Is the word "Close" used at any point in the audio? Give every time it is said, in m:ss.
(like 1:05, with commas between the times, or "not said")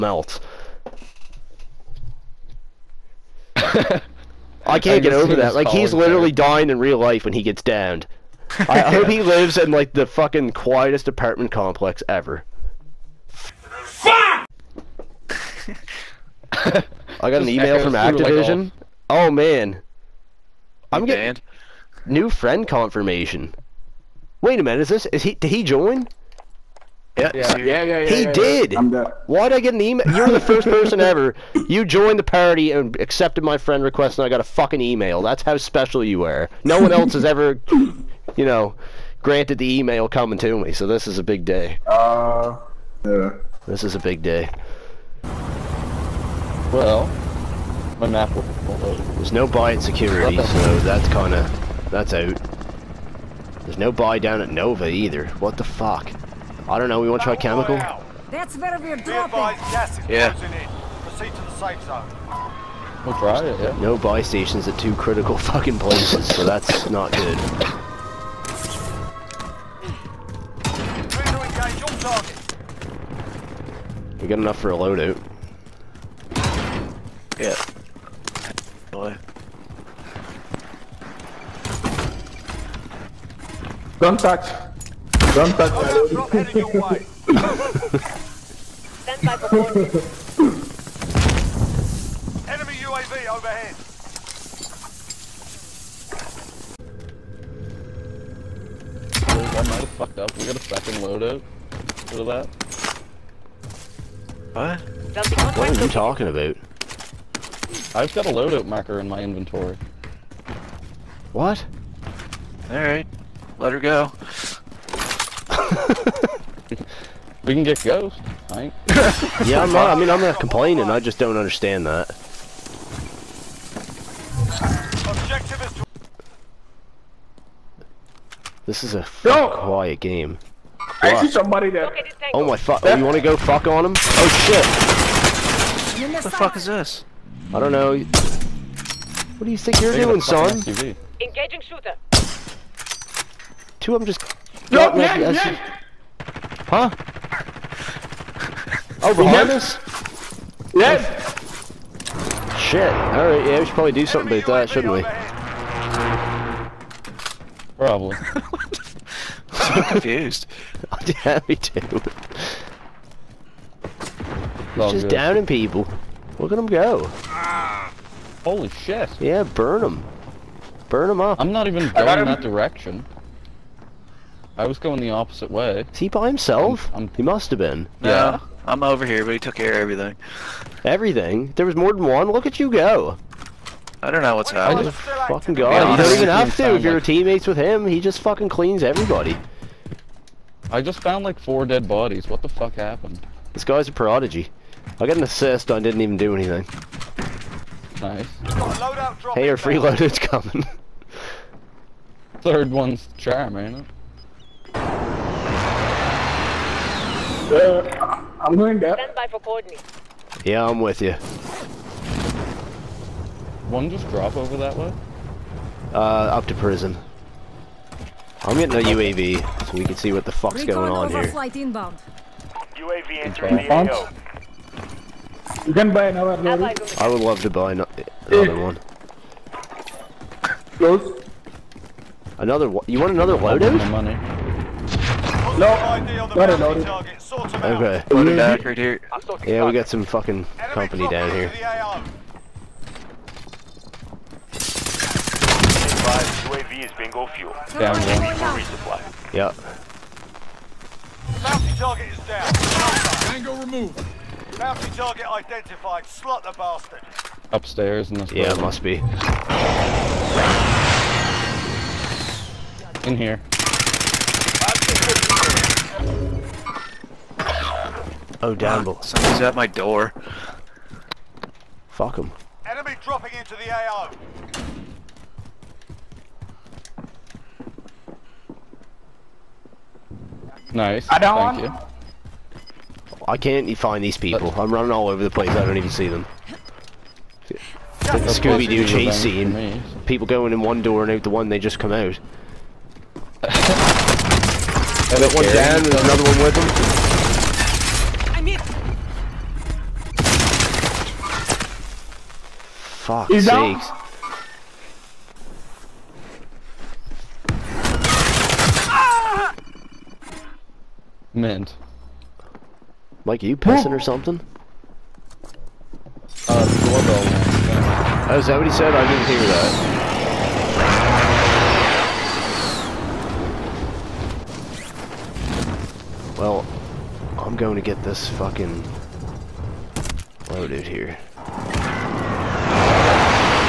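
3:50.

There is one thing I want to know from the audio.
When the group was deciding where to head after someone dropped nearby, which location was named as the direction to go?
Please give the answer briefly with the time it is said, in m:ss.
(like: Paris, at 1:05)
prison, at 3:36.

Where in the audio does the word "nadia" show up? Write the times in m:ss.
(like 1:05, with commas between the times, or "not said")
not said.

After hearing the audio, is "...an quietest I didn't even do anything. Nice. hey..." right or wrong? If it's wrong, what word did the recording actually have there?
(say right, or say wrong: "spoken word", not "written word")
wrong: "assist", not "quietest".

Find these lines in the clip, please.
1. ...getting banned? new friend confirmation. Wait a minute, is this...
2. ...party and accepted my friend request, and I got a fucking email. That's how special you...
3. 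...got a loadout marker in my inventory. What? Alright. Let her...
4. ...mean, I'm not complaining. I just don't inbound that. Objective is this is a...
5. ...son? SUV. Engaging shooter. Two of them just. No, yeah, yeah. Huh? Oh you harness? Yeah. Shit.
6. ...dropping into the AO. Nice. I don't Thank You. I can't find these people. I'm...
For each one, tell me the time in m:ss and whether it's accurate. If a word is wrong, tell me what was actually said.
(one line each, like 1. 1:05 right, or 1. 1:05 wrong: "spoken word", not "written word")
1. 0:21 right
2. 0:32 right
3. 1:48 right
4. 2:00 wrong: "understand", not "inbound"
5. 2:20 right
6. 4:33 right.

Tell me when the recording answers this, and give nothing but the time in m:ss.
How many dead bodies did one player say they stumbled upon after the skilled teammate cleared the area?
3:11.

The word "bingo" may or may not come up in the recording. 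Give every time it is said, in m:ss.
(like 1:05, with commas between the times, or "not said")
4:06, 4:13.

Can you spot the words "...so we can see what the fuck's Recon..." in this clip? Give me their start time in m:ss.
3:39.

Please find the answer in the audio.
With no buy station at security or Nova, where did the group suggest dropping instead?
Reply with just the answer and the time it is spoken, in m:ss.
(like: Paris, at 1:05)
chemical, at 0:57.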